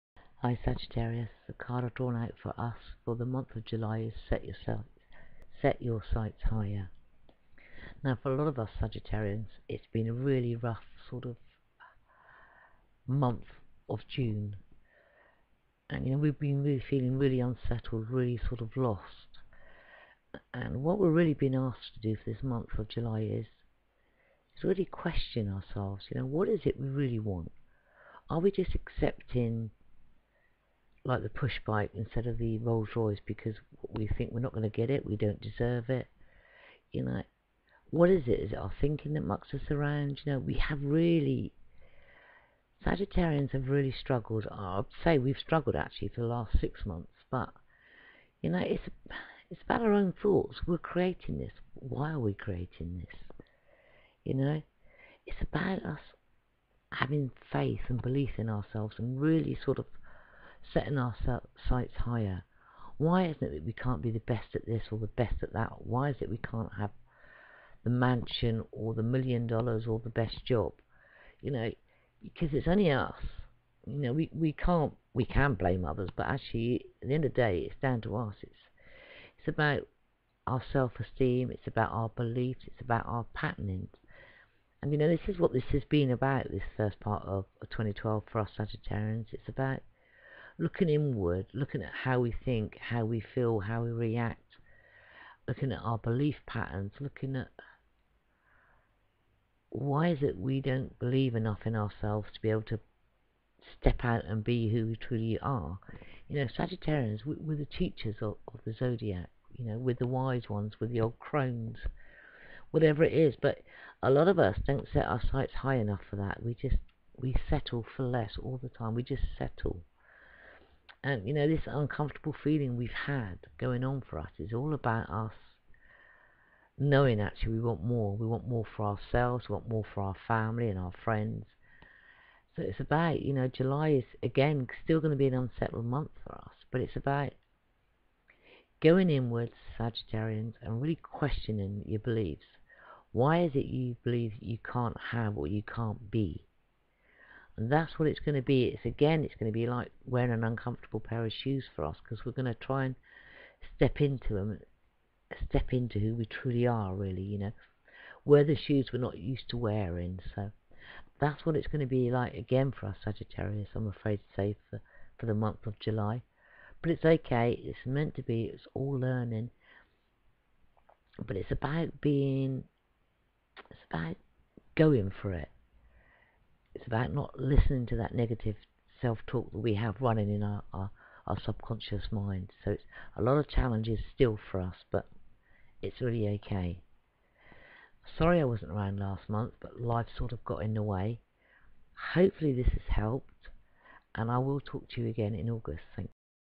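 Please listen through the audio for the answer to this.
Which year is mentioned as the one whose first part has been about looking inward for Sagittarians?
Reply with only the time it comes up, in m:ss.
1:27.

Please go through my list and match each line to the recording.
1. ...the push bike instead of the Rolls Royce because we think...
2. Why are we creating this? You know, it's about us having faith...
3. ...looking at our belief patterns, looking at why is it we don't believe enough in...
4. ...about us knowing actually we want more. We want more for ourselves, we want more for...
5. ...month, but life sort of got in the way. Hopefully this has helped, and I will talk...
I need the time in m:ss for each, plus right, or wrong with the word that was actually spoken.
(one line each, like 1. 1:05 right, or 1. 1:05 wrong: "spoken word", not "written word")
1. 0:31 right
2. 0:51 right
3. 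1:35 right
4. 2:04 right
5. 3:09 right.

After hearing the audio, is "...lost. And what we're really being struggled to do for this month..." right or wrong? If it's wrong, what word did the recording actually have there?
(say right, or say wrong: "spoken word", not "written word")
wrong: "asked", not "struggled".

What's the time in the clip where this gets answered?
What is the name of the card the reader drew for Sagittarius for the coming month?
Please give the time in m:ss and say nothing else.
0:05.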